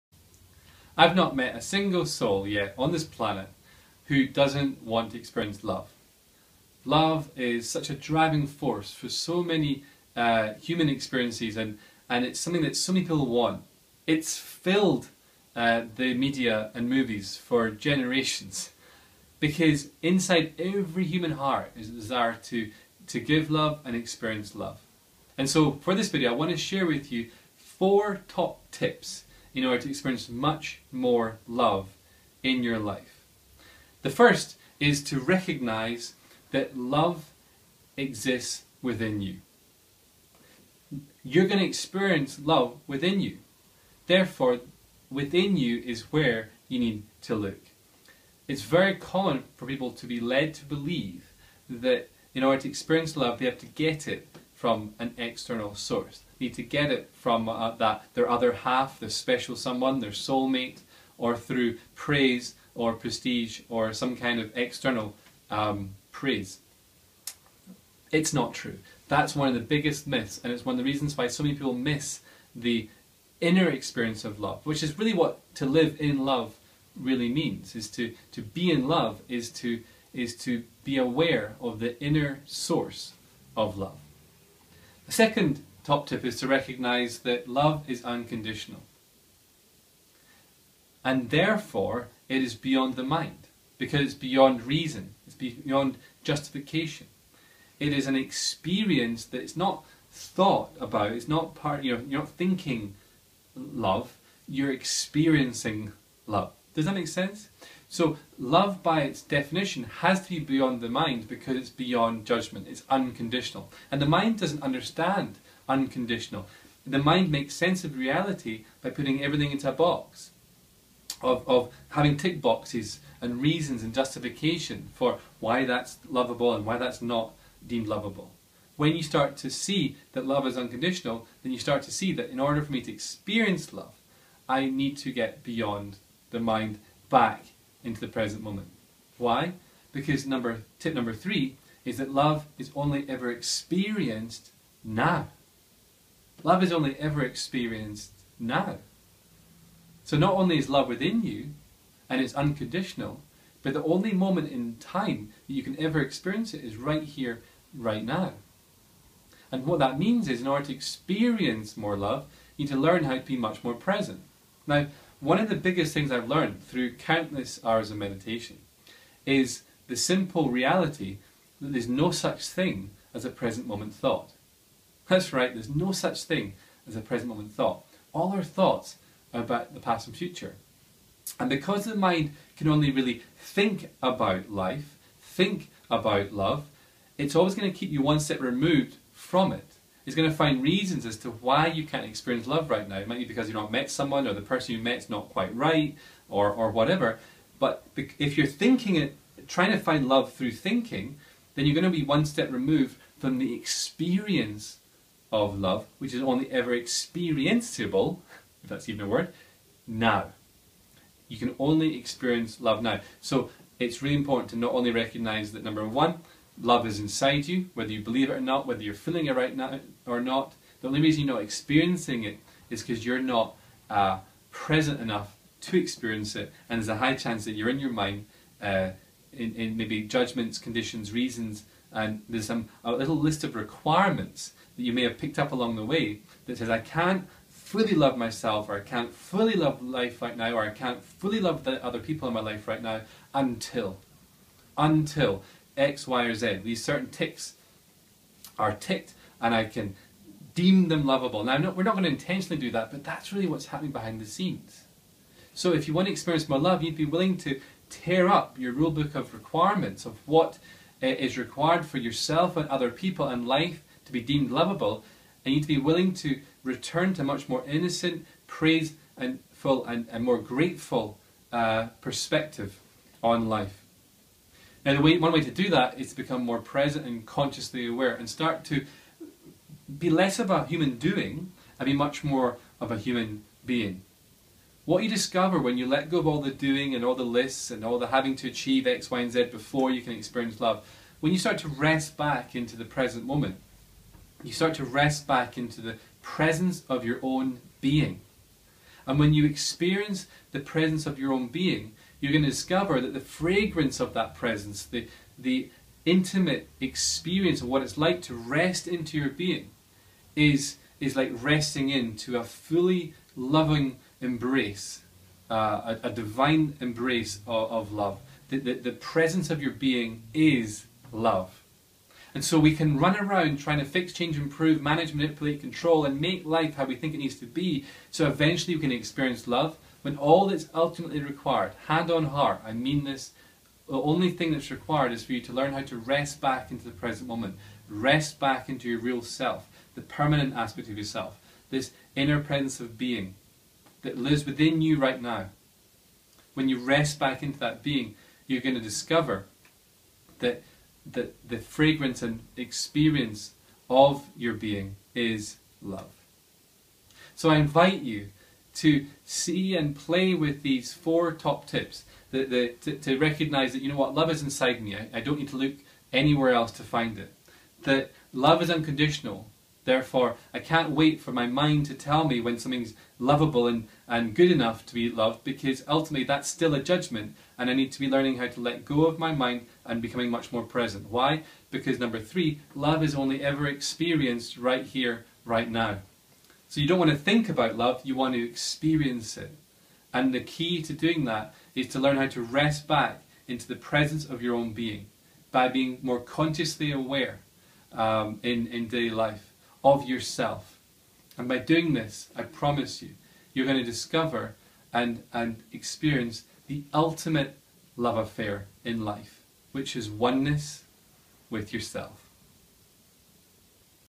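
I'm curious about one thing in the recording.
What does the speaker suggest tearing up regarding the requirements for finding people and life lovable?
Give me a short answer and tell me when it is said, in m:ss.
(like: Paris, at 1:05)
Rule book, at 4:18.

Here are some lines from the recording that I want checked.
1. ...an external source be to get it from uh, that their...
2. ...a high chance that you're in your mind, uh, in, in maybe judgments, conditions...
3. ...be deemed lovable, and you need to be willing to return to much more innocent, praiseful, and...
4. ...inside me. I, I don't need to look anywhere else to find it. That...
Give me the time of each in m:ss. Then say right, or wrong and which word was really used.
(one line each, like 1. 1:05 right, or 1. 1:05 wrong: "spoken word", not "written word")
1. 0:54 right
2. 3:46 right
3. 4:24 right
4. 6:04 right.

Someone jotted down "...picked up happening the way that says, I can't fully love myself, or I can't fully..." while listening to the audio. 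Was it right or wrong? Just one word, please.
wrong.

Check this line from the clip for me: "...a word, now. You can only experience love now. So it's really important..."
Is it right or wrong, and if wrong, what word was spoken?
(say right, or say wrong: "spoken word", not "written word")
right.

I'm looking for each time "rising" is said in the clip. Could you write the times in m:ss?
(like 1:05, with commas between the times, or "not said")
not said.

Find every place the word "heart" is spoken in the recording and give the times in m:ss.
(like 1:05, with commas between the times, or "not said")
0:21, 5:32.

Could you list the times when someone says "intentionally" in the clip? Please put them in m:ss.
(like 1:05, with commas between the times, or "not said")
4:12.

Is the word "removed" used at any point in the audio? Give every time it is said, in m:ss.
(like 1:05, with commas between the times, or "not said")
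3:08, 3:22.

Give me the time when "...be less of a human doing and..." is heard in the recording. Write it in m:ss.
4:39.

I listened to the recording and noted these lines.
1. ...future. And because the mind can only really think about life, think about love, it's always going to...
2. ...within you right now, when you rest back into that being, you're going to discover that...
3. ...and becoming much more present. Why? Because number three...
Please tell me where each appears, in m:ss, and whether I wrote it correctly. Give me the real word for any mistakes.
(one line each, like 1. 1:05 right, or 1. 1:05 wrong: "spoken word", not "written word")
1. 3:00 right
2. 5:44 right
3. 6:19 right.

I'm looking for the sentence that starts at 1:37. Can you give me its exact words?
It is an experience that it's not thought about, it's not part, you know, you're not thinking love, you're experiencing love.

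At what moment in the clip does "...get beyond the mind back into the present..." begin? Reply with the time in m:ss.
2:15.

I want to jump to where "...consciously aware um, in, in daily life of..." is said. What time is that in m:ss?
6:36.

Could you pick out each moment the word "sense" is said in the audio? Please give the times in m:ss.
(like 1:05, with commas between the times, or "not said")
1:47, 1:57.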